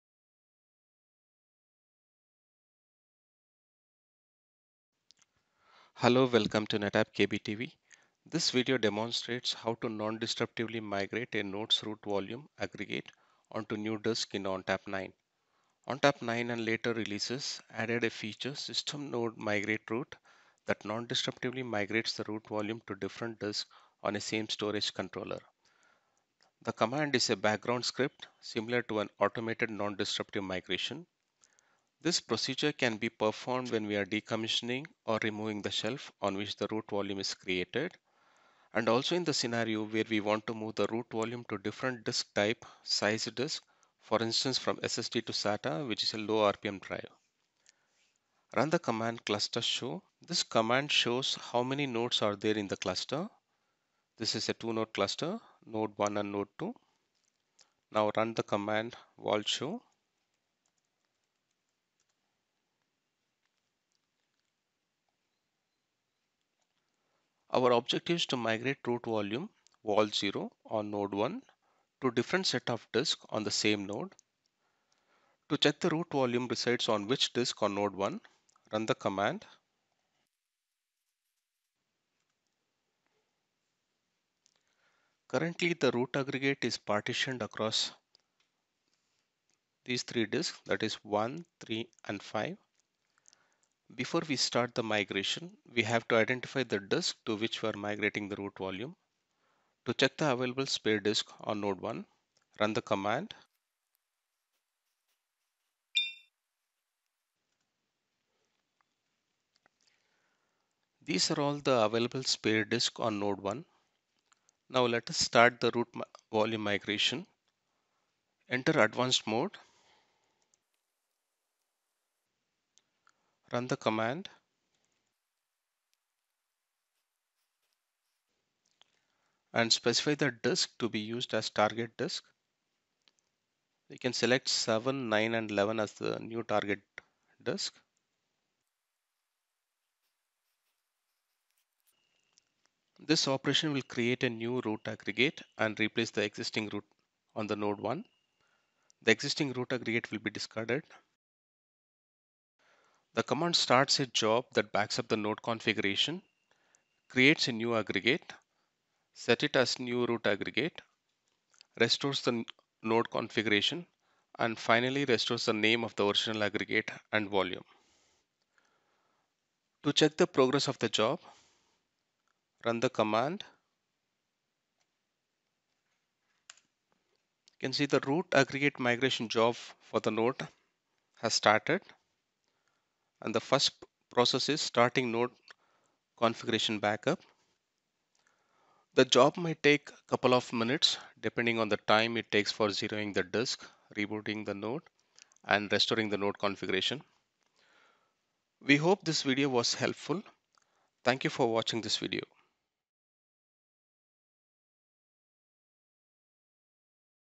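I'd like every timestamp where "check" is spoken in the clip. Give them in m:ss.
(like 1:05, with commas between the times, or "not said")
1:15, 1:39, 2:49.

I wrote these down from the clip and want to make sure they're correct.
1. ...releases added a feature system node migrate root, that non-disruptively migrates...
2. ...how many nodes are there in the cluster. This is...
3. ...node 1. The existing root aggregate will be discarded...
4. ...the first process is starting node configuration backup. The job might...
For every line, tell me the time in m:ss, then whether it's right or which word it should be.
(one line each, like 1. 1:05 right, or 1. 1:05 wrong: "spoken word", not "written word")
1. 0:16 right
2. 0:51 right
3. 2:27 right
4. 3:03 right.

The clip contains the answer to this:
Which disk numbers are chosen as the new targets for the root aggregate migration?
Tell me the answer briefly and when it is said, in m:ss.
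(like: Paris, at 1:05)
7, 9 and 11, at 2:14.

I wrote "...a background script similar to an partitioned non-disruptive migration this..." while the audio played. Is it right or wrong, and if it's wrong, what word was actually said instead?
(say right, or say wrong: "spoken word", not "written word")
wrong: "automated", not "partitioned".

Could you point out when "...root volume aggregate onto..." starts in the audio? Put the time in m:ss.
0:11.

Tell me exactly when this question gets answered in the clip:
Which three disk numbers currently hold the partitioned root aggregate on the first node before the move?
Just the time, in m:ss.
1:31.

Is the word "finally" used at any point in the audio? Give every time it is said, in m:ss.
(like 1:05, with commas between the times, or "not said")
2:44.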